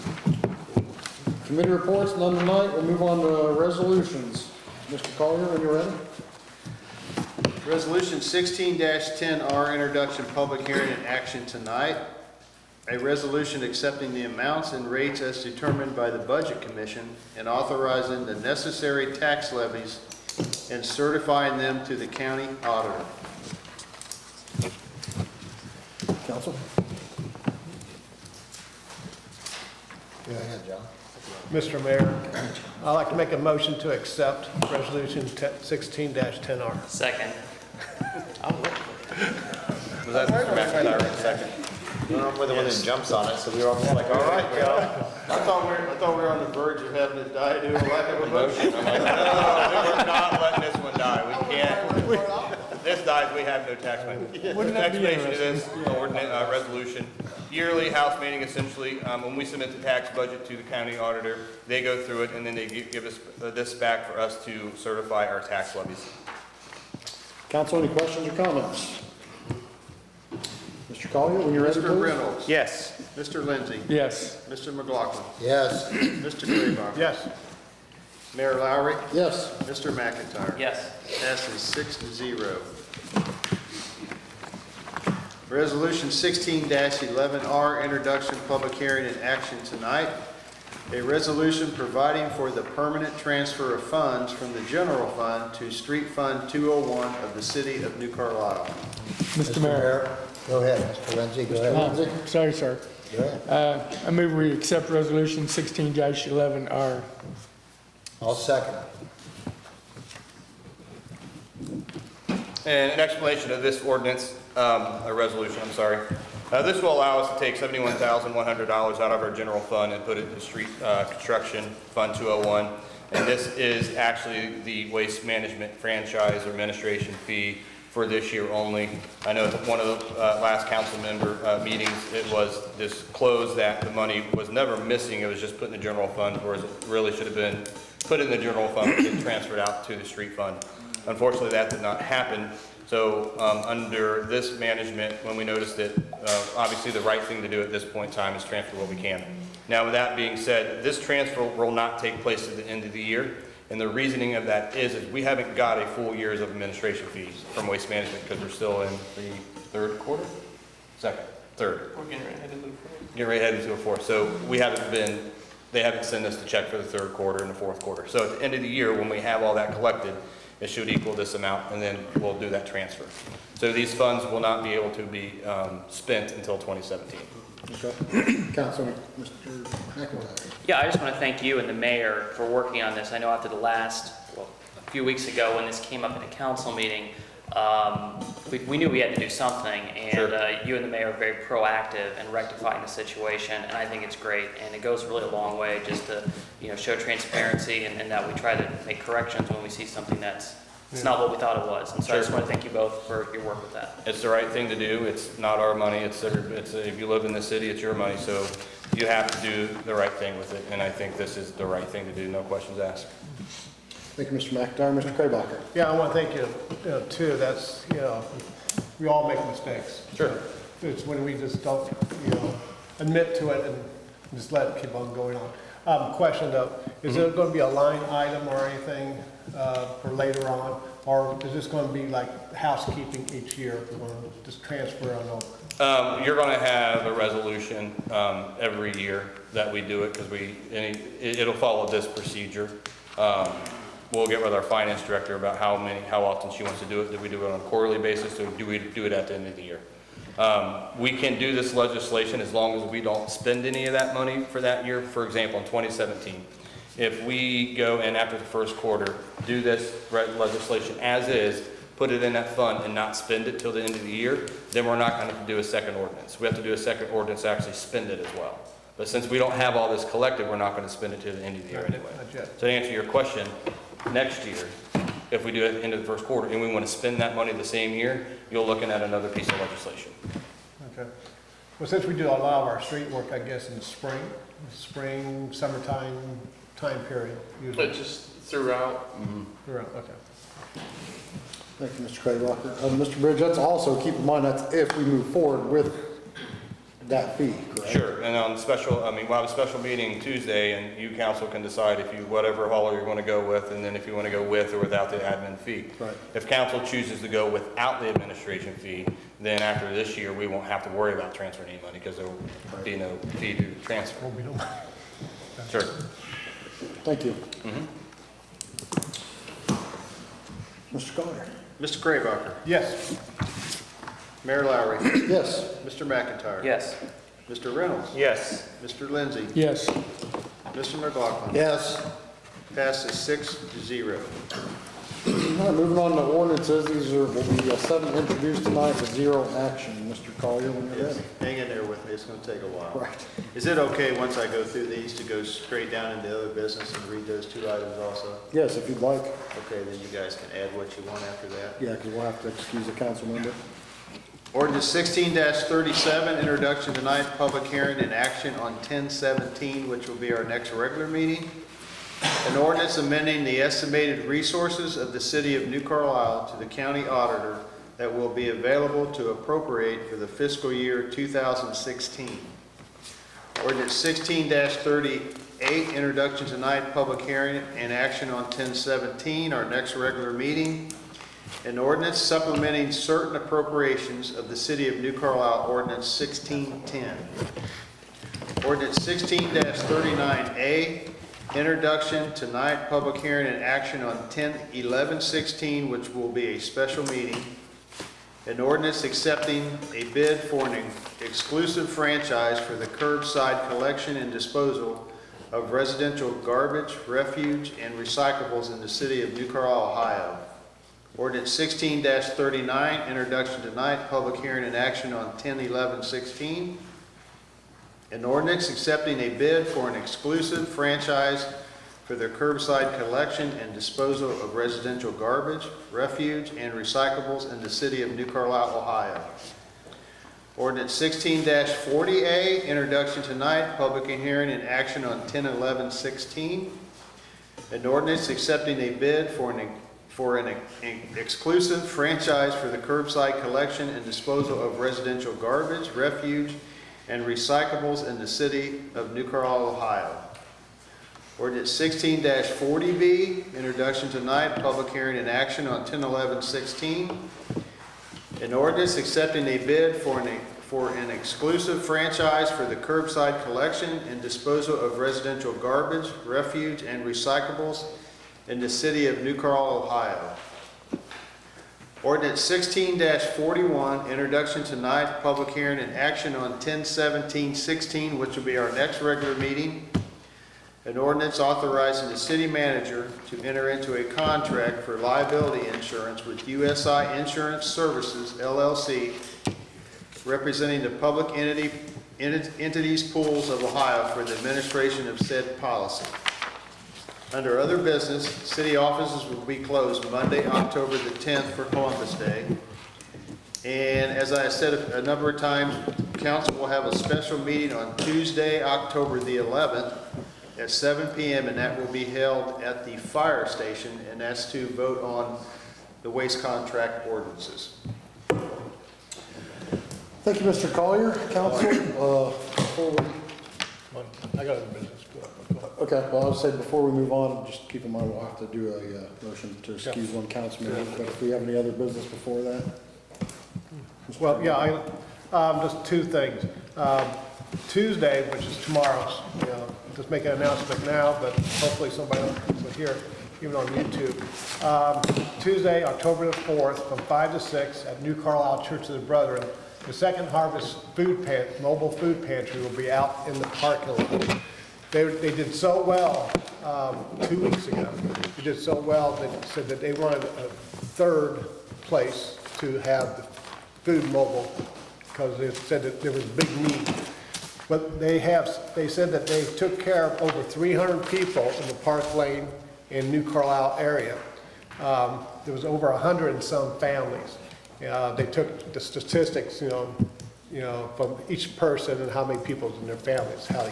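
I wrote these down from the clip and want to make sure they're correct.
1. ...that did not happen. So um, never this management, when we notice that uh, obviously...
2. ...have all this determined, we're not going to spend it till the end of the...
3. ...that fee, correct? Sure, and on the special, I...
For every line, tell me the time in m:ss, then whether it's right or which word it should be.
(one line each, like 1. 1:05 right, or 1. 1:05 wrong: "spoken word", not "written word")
1. 2:21 wrong: "under", not "never"
2. 4:29 wrong: "collected", not "determined"
3. 4:57 right.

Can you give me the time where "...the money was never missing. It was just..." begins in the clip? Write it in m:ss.
2:13.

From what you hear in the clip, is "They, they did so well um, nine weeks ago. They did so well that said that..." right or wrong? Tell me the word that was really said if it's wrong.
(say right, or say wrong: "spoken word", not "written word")
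wrong: "two", not "nine".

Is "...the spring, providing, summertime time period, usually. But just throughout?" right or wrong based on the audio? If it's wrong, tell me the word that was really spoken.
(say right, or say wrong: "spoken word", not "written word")
wrong: "spring", not "providing".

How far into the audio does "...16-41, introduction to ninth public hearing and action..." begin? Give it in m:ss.
7:52.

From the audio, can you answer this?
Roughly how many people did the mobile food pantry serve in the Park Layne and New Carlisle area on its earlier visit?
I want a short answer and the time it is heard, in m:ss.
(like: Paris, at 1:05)
Over 300, at 9:30.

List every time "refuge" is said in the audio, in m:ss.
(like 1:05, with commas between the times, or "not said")
6:47, 7:05, 7:25, 7:46.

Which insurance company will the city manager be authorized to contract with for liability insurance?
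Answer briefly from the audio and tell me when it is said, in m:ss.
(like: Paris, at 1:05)
USI Insurance Services LLC, at 8:06.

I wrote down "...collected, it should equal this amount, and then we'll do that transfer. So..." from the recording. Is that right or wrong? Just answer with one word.
right.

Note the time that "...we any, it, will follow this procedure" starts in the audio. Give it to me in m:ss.
4:00.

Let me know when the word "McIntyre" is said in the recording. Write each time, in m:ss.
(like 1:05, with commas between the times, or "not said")
0:40, 1:19, 3:34, 5:26.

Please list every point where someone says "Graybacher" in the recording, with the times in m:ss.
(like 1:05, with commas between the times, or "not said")
1:16, 5:22.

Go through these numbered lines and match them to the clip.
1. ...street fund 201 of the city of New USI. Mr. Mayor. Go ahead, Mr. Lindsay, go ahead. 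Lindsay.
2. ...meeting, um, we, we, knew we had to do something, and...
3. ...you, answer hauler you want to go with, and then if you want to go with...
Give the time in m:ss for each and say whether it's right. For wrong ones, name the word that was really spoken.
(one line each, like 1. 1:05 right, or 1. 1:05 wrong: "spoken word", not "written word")
1. 1:35 wrong: "Carlisle", not "USI"
2. 3:06 right
3. 5:02 wrong: "whatever", not "answer".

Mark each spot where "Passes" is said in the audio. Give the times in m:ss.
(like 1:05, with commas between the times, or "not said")
1:21, 5:32.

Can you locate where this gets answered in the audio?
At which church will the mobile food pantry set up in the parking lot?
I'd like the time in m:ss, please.
9:08.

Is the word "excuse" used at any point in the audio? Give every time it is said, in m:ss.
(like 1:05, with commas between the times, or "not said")
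5:52, 8:49.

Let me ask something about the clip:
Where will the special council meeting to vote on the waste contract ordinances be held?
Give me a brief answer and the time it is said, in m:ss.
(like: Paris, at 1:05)
The fire station, at 8:32.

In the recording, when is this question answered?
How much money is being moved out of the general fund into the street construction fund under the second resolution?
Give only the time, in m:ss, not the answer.
1:57.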